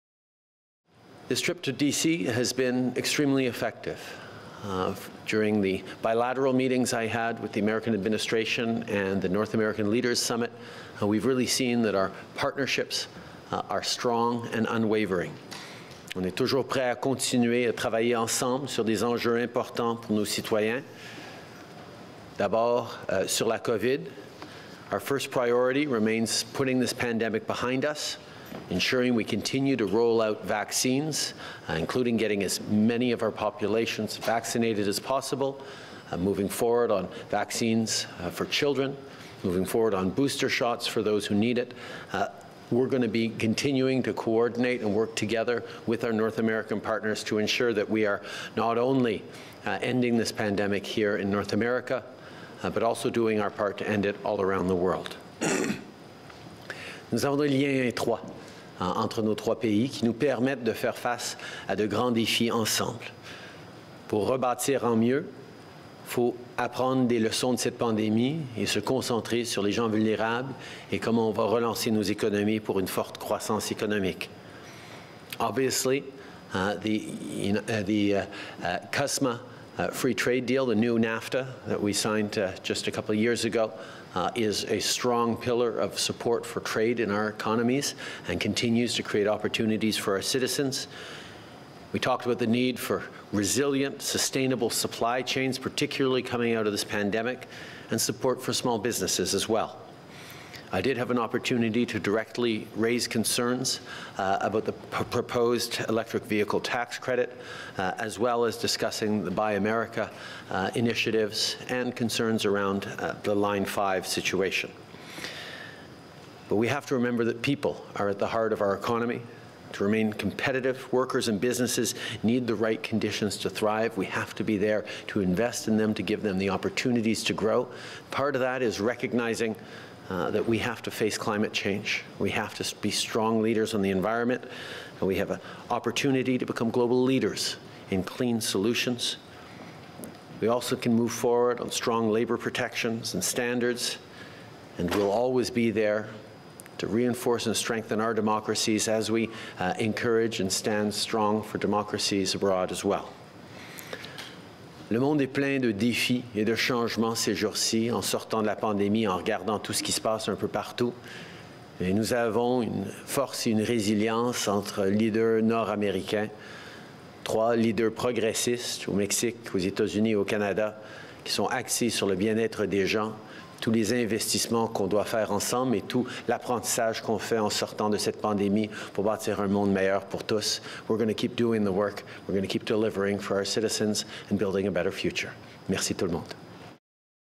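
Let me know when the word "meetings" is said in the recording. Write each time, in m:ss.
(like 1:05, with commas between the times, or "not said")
0:06.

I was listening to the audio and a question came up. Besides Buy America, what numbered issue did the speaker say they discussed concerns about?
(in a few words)
Line 5.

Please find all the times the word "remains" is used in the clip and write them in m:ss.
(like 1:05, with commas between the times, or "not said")
0:25, 1:59.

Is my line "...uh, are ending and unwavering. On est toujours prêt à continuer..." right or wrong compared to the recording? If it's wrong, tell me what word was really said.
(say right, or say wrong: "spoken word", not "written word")
wrong: "strong", not "ending".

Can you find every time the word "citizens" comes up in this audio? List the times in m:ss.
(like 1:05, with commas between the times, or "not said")
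1:30, 3:03.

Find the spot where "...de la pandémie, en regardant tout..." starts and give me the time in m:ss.
2:38.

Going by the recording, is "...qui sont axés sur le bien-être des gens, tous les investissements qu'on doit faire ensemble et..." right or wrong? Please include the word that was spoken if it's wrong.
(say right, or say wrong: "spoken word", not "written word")
right.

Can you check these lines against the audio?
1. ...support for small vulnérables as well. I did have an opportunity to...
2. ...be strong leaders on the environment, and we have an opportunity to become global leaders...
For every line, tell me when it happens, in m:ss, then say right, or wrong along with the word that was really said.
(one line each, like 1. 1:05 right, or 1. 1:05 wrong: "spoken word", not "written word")
1. 1:37 wrong: "businesses", not "vulnérables"
2. 2:12 right.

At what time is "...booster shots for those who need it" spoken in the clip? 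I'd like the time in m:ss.
0:40.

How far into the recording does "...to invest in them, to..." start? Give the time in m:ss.
2:05.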